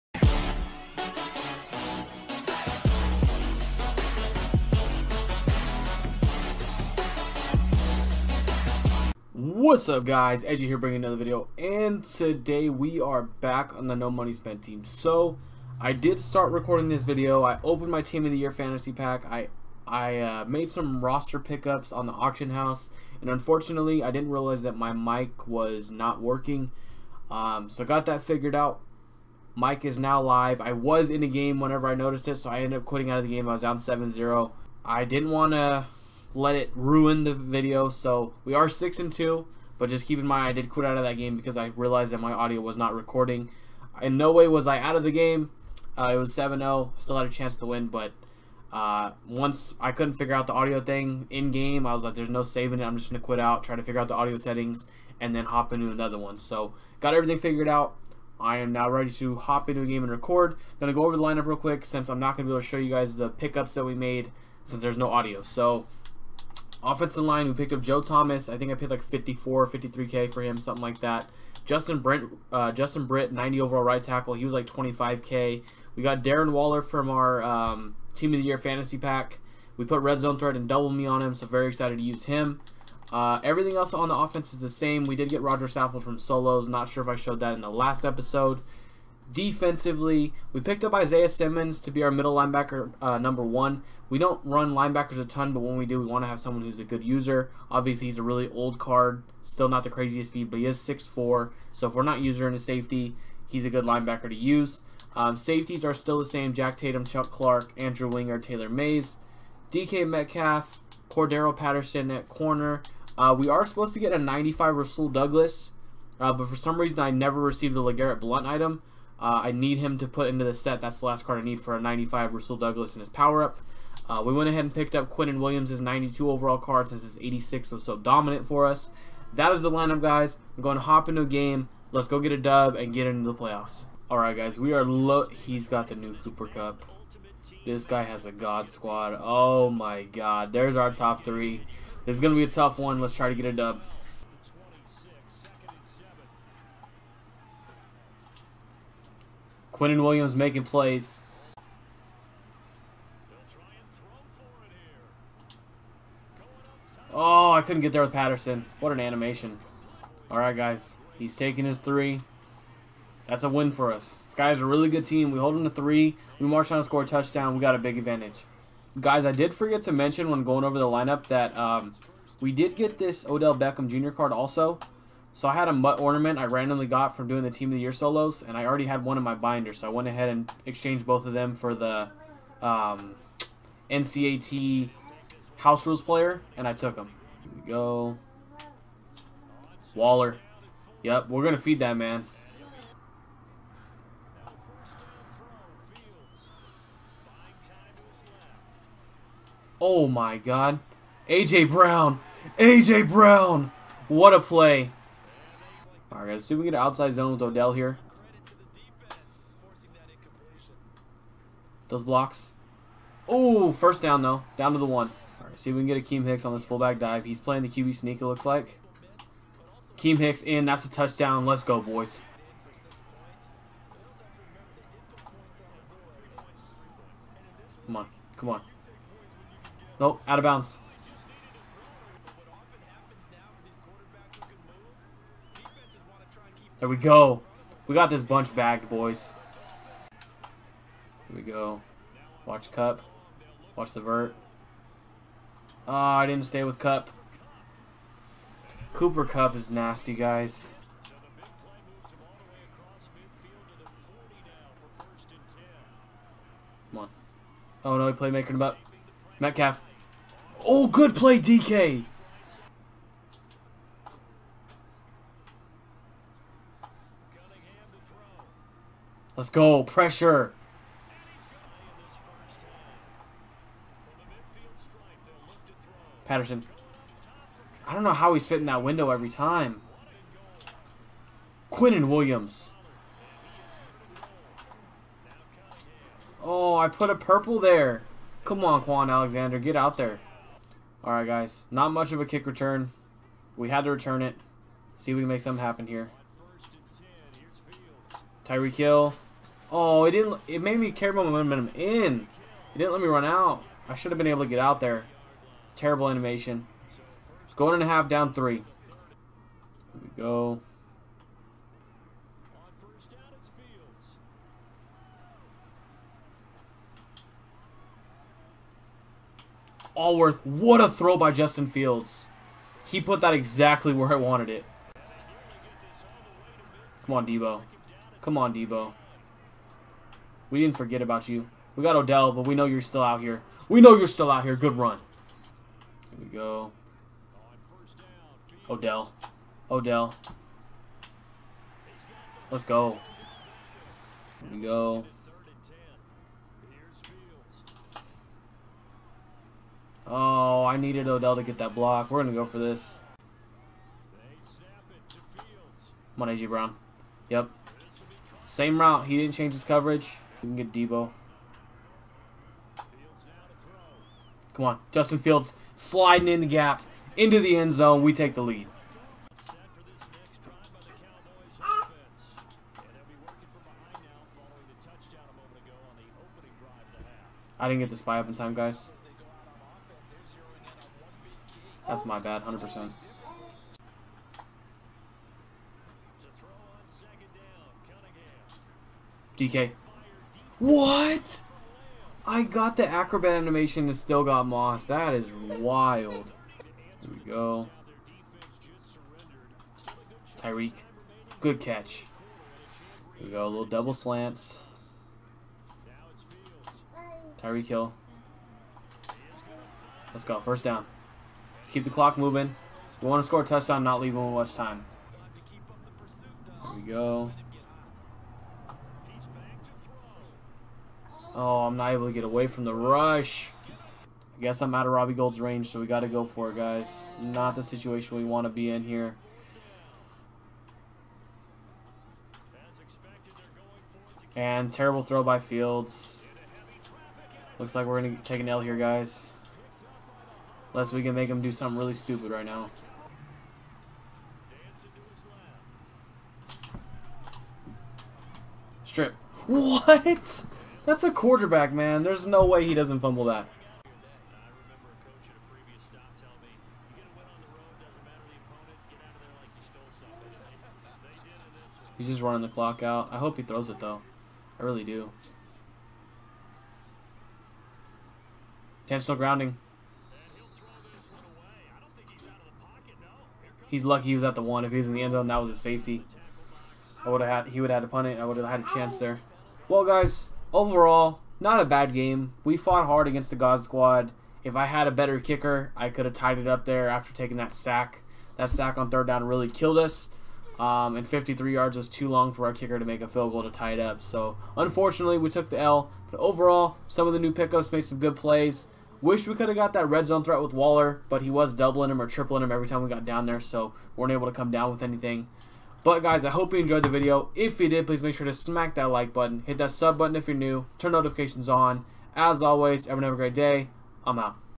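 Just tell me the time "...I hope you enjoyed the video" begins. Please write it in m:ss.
8:26.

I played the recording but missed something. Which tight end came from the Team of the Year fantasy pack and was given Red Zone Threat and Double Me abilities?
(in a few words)
Darren Waller.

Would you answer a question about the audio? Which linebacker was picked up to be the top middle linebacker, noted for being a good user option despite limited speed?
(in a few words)
Isaiah Simmons.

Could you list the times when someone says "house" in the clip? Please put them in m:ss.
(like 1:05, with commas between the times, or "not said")
0:22, 3:05.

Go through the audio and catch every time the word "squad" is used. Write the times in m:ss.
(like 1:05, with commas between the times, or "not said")
2:18, 8:03.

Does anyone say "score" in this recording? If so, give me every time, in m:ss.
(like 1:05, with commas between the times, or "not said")
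2:46, 6:53.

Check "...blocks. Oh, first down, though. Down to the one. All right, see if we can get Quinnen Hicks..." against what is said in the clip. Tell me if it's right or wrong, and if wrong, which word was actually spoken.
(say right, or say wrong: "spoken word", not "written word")
wrong: "Akiem", not "Quinnen".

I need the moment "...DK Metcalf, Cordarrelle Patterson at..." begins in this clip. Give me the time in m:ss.
1:49.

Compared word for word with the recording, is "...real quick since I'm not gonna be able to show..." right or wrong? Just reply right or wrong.
right.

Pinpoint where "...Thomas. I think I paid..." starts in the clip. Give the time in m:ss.
1:08.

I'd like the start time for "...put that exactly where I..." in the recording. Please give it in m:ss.
5:22.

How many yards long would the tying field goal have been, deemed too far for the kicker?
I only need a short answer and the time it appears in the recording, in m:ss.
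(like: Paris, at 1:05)
53, at 8:11.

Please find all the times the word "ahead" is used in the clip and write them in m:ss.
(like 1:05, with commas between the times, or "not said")
2:04, 3:00.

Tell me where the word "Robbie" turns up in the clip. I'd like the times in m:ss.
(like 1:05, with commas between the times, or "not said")
7:04.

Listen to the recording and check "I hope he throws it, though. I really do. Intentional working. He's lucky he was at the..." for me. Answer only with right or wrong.
wrong.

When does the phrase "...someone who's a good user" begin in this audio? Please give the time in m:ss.
1:36.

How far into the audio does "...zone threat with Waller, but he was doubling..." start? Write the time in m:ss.
8:20.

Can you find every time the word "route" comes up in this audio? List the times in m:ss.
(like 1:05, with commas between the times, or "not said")
5:58.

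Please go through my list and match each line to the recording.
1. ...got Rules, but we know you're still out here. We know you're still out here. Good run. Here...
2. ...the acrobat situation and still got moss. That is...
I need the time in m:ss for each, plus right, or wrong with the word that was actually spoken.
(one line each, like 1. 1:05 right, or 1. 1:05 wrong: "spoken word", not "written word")
1. 5:31 wrong: "Odell", not "Rules"
2. 6:32 wrong: "animation", not "situation".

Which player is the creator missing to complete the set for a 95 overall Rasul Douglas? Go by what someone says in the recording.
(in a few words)
LeGarrette Blount.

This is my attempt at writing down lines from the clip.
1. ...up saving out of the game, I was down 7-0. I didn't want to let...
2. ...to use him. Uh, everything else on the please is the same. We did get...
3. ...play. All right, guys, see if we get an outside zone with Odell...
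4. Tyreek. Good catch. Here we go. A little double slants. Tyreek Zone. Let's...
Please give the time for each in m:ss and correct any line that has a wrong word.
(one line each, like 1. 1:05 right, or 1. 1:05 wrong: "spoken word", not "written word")
1. 0:32 wrong: "quitting", not "saving"
2. 1:21 wrong: "offense", not "please"
3. 3:24 right
4. 6:40 wrong: "Hill", not "Zone".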